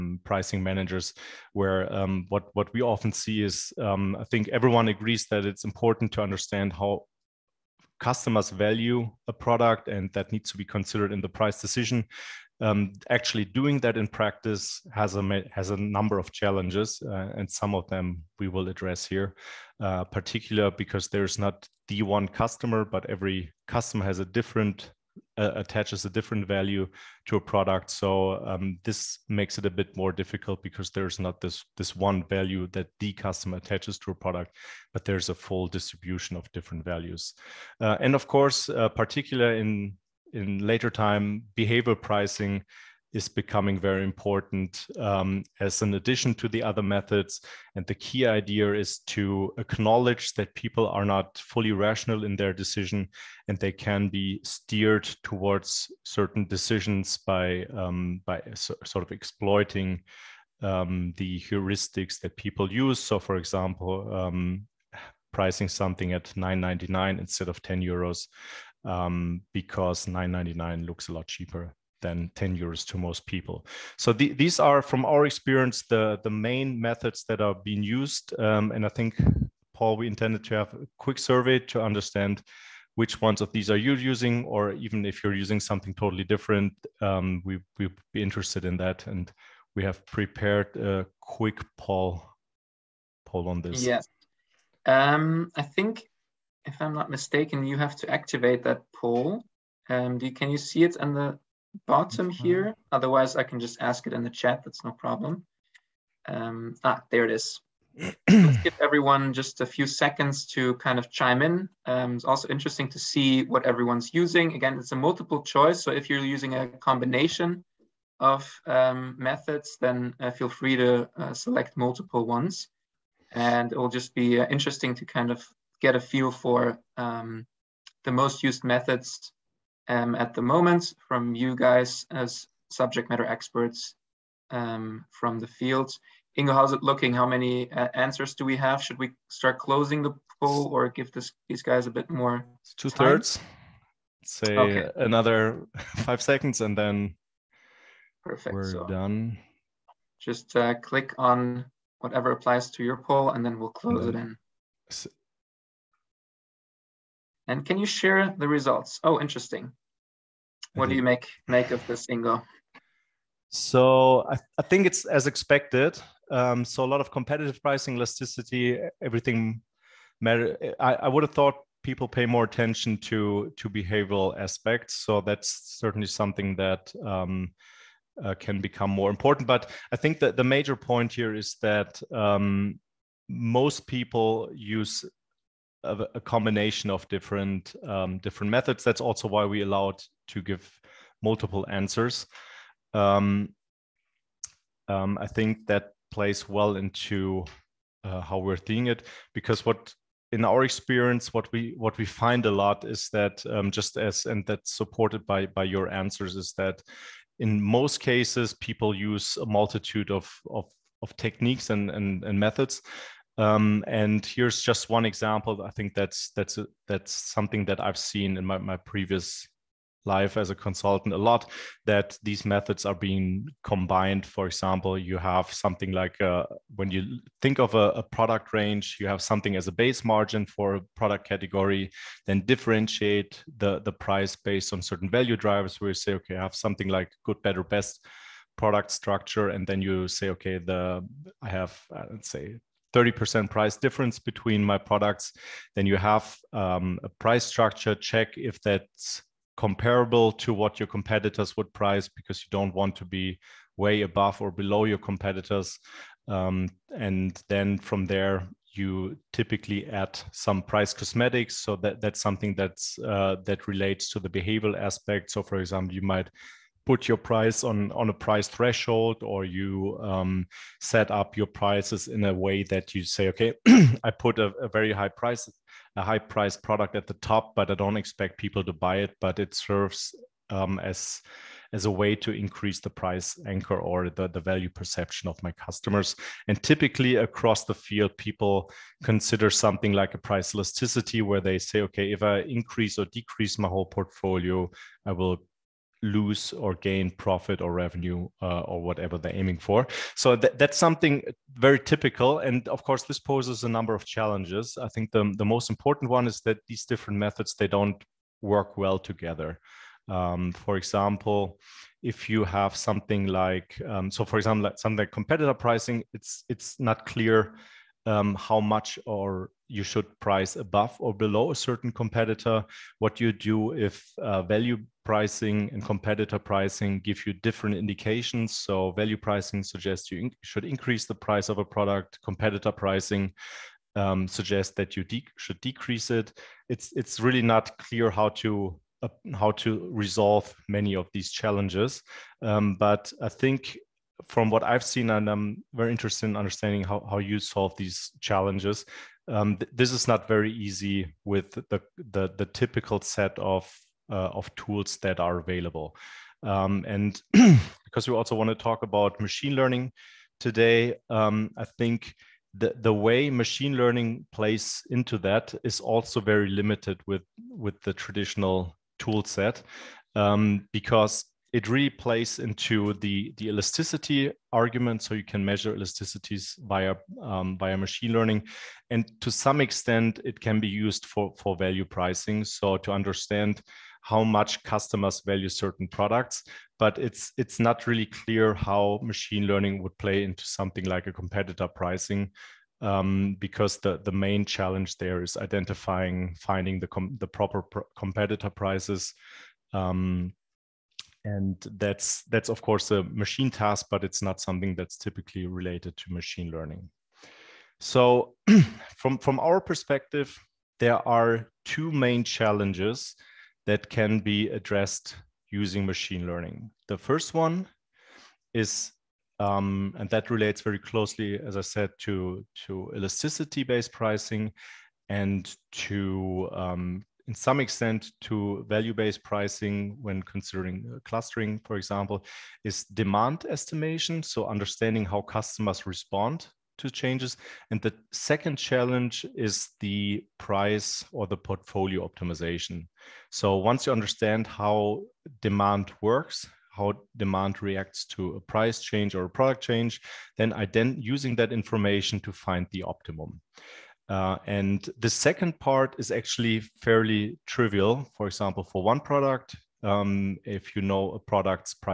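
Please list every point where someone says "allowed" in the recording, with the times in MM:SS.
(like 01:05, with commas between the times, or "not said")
03:09.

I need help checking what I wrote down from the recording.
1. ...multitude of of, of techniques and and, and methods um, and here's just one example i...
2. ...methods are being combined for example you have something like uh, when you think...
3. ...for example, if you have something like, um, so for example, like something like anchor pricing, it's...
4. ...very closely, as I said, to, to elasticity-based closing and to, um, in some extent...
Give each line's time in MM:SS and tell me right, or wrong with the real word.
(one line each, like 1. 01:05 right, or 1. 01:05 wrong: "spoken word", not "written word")
1. 03:29 right
2. 03:42 right
3. 05:10 wrong: "competitor", not "anchor"
4. 07:00 wrong: "pricing", not "closing".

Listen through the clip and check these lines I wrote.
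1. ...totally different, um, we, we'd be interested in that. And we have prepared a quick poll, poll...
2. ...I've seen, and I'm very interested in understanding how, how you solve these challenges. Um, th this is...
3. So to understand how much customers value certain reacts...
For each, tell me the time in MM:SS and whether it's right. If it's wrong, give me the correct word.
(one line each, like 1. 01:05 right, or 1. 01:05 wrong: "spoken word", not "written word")
1. 01:25 right
2. 05:44 right
3. 06:22 wrong: "products", not "reacts".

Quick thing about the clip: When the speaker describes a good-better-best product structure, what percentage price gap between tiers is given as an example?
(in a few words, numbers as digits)
30%.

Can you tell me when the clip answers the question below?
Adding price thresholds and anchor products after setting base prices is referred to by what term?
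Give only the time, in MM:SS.
04:20.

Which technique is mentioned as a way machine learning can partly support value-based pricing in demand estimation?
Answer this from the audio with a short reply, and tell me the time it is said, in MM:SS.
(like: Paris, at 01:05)
clustering, at 07:11.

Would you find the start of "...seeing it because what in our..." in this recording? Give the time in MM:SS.
03:18.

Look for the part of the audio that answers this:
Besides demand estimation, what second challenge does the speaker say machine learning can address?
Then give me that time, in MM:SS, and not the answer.
07:21.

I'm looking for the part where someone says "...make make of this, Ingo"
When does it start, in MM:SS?
02:41.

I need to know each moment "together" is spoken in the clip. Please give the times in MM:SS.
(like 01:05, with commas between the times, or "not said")
05:08.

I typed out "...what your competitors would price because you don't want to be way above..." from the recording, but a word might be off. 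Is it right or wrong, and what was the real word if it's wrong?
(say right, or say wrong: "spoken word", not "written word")
right.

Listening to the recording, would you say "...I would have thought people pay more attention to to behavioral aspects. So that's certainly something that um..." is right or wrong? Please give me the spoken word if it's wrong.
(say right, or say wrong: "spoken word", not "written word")
right.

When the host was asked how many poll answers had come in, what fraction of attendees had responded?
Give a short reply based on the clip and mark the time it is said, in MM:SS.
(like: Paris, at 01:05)
two thirds, at 02:22.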